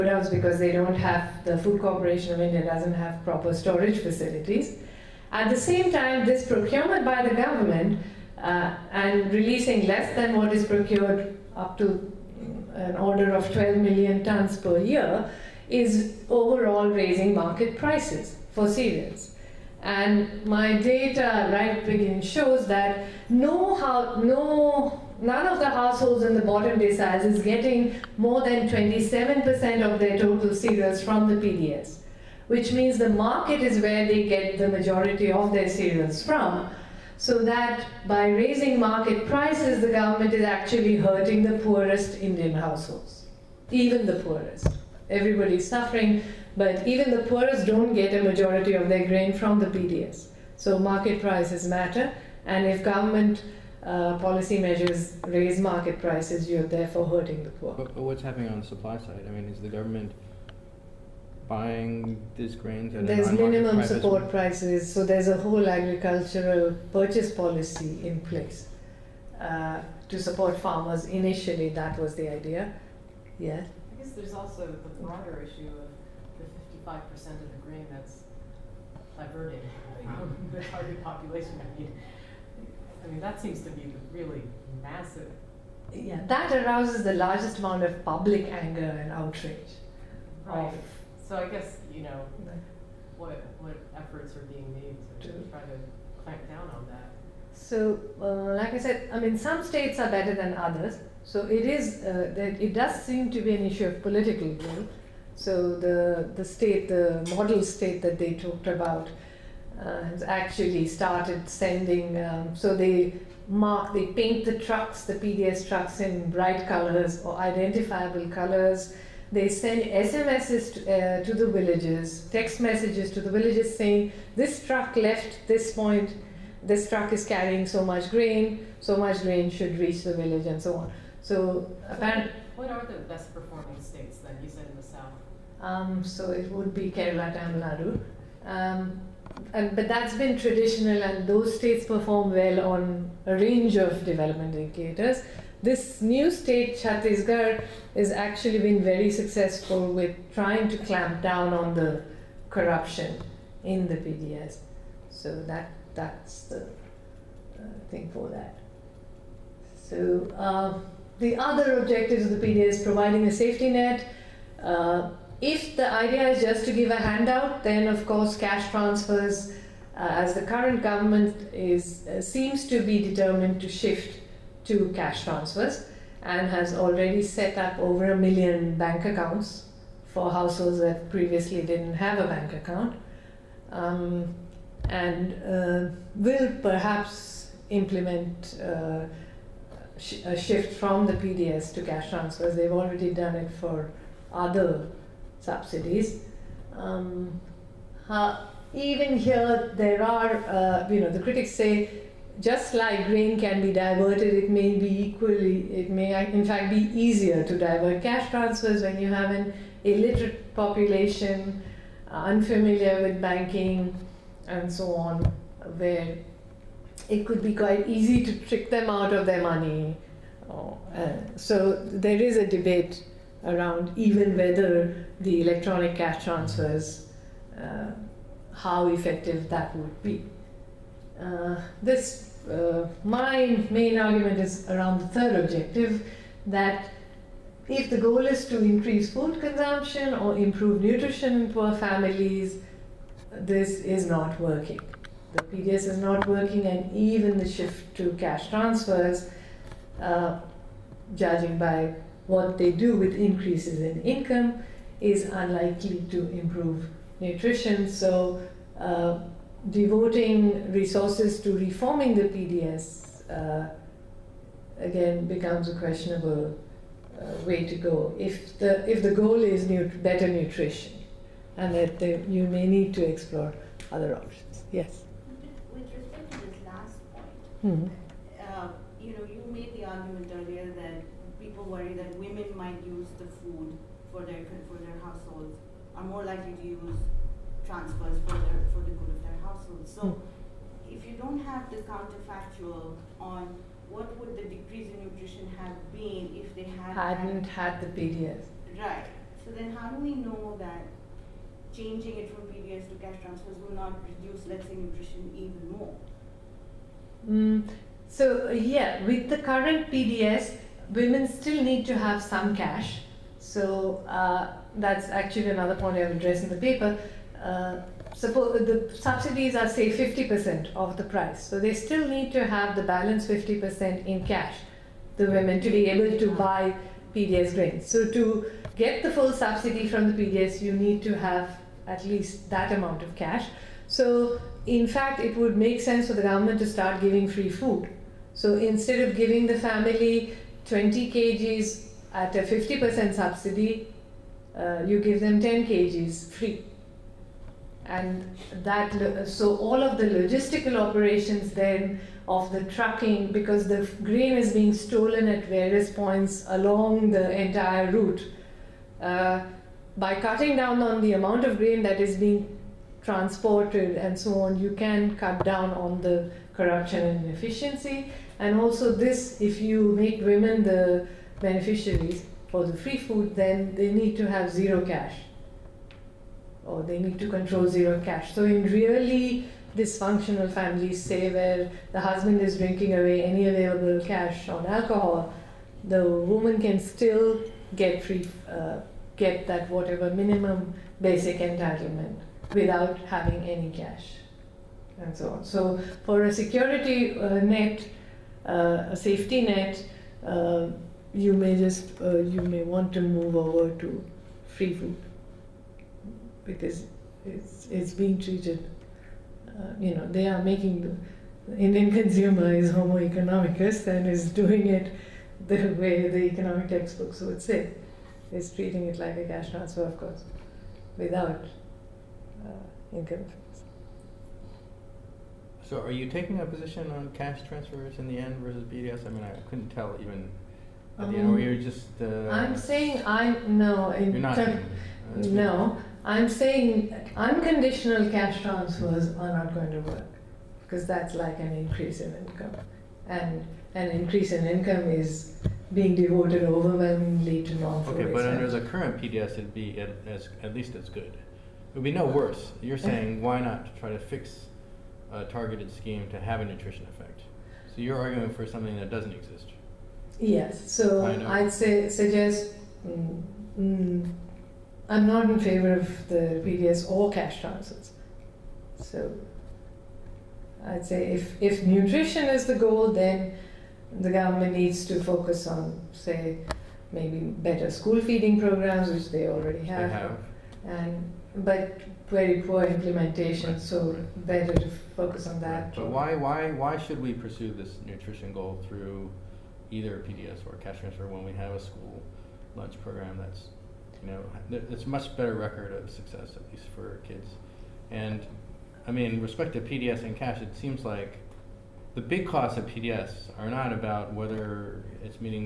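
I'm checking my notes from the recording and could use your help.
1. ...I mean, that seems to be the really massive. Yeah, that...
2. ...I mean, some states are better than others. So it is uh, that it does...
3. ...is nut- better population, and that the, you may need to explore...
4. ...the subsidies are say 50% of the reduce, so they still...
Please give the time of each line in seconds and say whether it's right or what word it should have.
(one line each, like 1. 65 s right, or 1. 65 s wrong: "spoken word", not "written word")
1. 83 s right
2. 99 s right
3. 269 s wrong: "nutrition", not "population"
4. 318 s wrong: "price", not "reduce".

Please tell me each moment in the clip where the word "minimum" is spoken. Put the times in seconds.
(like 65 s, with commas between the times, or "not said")
63 s, 390 s.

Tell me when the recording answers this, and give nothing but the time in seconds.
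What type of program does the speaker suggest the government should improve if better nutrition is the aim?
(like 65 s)
477 s.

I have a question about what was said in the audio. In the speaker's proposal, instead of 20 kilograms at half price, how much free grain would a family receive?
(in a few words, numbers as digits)
10 kg.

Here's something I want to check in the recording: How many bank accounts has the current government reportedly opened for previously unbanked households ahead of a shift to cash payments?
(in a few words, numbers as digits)
Over a million.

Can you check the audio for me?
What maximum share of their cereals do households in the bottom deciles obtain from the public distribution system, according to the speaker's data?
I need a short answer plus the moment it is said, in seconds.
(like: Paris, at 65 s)
27%, at 28 s.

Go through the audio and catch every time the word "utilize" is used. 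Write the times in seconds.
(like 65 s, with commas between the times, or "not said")
not said.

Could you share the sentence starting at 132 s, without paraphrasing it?
What are the best performing states then?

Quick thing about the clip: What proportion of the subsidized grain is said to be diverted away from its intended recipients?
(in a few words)
55%.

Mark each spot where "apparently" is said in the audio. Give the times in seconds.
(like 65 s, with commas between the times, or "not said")
131 s.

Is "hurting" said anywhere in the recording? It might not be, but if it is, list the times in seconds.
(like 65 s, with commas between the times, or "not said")
40 s, 57 s.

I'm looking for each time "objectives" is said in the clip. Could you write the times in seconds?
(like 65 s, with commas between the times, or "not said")
161 s, 235 s.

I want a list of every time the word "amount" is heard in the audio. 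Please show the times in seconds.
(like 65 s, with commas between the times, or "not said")
87 s, 332 s, 361 s.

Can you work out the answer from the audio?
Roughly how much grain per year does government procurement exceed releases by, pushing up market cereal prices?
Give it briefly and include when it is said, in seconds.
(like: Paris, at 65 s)
12 million tons, at 13 s.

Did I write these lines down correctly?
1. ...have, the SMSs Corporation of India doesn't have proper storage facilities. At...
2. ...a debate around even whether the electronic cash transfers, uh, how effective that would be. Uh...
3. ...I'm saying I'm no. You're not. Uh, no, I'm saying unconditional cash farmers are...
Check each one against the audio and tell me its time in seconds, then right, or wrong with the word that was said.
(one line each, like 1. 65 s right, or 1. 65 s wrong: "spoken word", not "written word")
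1. 0 s wrong: "Food", not "SMSs"
2. 222 s right
3. 432 s wrong: "transfers", not "farmers".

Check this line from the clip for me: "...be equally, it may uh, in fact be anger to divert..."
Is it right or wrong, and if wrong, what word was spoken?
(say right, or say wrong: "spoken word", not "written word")
wrong: "easier", not "anger".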